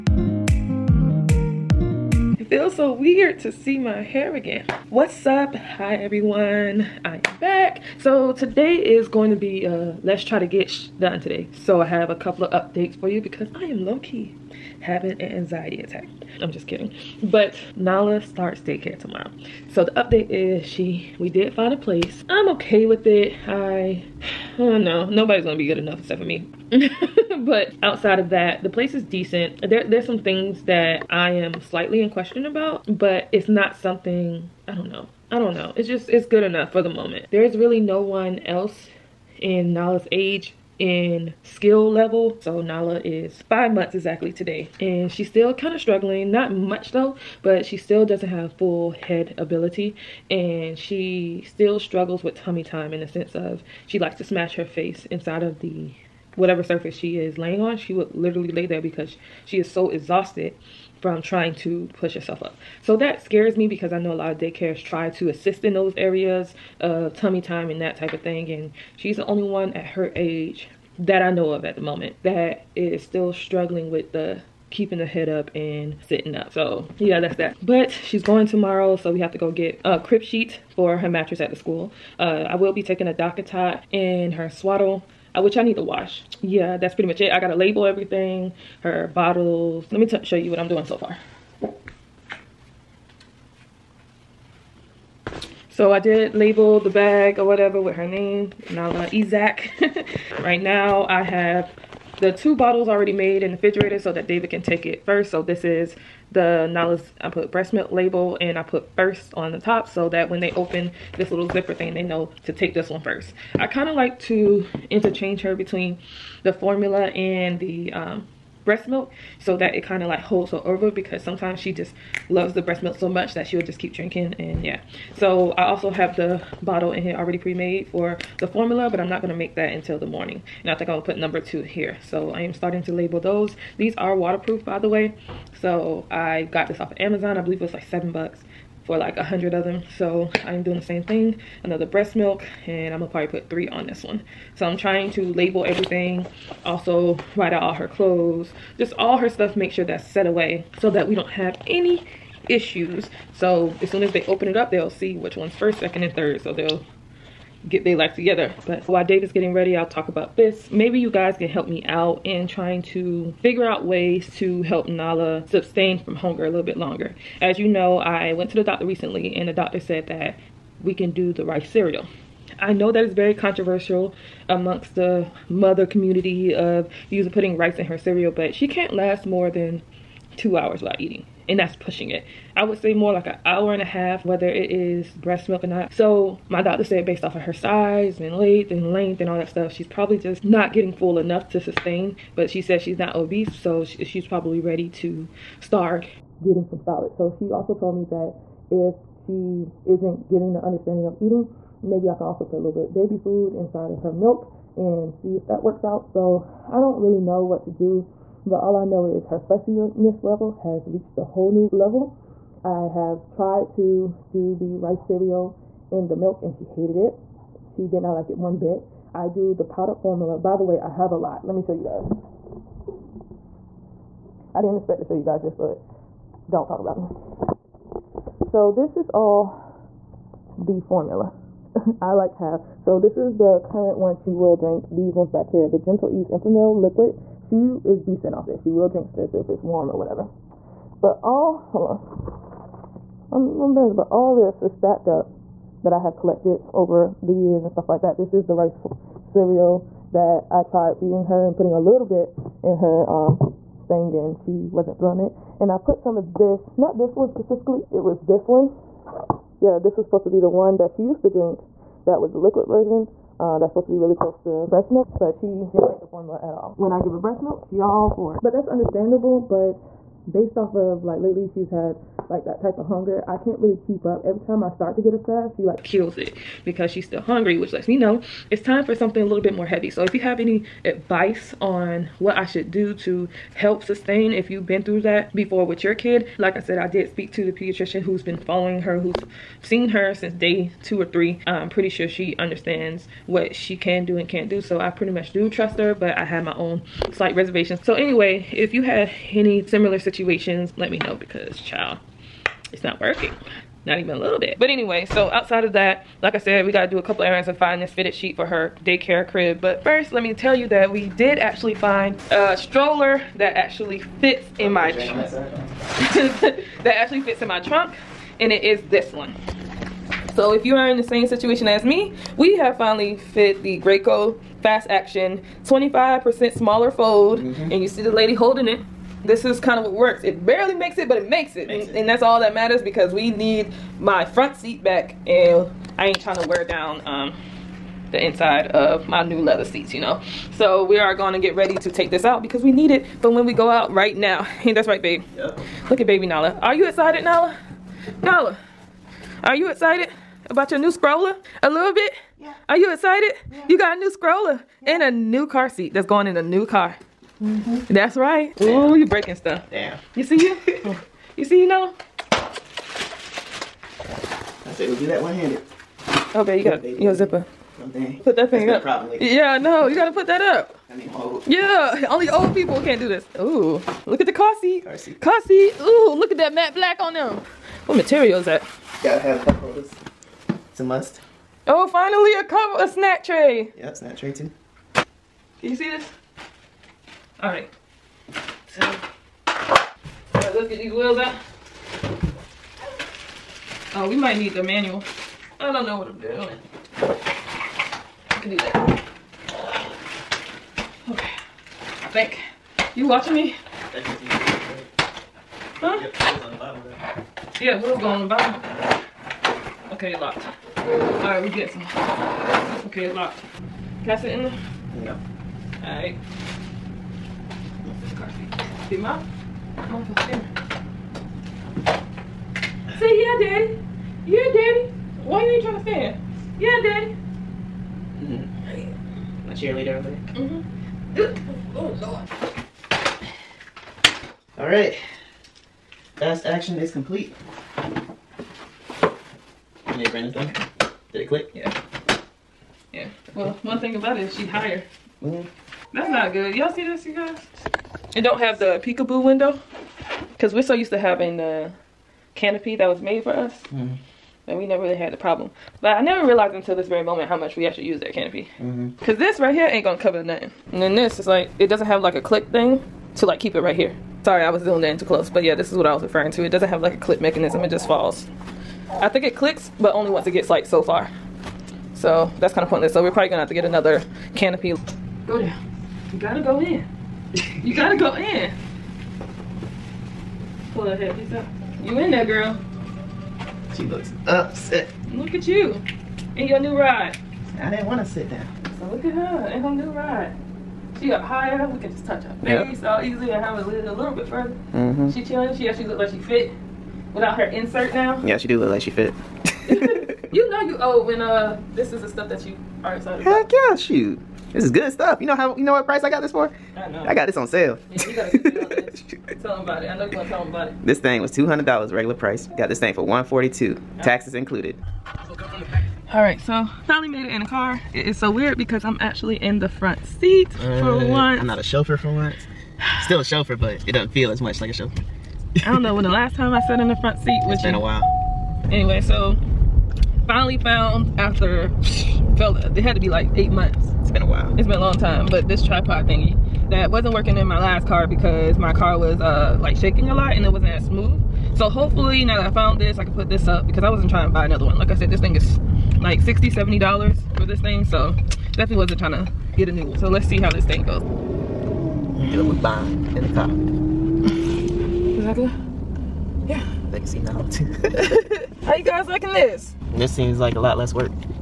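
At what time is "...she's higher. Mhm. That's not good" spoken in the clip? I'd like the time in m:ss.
7:24.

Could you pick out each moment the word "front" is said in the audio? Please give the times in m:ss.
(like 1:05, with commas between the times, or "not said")
5:34, 8:39, 8:47.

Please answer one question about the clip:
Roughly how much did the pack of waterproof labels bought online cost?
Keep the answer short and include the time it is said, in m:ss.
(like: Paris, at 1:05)
7 bucks, at 2:17.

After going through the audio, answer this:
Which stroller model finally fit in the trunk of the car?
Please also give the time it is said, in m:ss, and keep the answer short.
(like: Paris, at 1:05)
Graco fast action, at 5:23.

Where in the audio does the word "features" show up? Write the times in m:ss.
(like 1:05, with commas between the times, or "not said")
not said.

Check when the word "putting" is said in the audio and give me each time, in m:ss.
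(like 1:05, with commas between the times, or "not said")
2:57, 4:11.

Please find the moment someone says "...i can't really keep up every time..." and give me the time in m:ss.
4:33.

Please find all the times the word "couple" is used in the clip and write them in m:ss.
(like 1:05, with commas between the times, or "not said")
0:12, 5:07.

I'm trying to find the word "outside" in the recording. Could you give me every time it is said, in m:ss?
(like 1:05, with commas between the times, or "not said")
0:27, 5:05.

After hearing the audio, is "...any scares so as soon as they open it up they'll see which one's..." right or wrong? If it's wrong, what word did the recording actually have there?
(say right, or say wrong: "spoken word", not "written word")
wrong: "issues", not "scares".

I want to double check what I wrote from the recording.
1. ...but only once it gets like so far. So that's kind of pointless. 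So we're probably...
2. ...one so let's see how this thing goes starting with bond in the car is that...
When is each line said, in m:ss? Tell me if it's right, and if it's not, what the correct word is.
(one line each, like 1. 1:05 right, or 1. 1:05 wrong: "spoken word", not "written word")
1. 7:49 right
2. 9:09 wrong: "dealing", not "starting".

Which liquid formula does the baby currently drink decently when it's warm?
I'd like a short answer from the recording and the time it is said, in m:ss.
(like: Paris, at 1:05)
Gentle Ease Enfamil, at 3:55.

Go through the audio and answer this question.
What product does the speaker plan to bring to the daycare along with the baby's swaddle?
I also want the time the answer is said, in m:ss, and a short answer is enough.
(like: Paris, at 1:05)
DockATot, at 1:23.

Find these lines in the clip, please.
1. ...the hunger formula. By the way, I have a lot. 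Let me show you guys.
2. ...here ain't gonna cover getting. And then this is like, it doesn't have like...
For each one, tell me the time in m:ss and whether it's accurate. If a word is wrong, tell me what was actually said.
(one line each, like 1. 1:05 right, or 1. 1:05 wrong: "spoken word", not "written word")
1. 3:39 wrong: "powder", not "hunger"
2. 7:39 wrong: "nothing", not "getting".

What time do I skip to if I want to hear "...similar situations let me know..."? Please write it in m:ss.
4:59.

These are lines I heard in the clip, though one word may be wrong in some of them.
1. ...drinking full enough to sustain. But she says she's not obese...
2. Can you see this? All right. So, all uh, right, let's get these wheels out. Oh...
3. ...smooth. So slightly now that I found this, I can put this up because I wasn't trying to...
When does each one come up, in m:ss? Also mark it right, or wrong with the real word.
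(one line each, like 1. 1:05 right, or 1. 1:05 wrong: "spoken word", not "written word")
1. 3:10 wrong: "getting", not "drinking"
2. 6:24 right
3. 9:00 wrong: "hopefully", not "slightly".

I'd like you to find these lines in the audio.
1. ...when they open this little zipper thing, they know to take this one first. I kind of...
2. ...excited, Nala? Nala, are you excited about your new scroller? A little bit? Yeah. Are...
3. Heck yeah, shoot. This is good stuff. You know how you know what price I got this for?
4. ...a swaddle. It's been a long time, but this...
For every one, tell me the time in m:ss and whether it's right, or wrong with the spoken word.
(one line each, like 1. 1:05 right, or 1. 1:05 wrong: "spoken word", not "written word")
1. 1:50 right
2. 5:46 right
3. 8:23 right
4. 8:54 wrong: "while", not "swaddle".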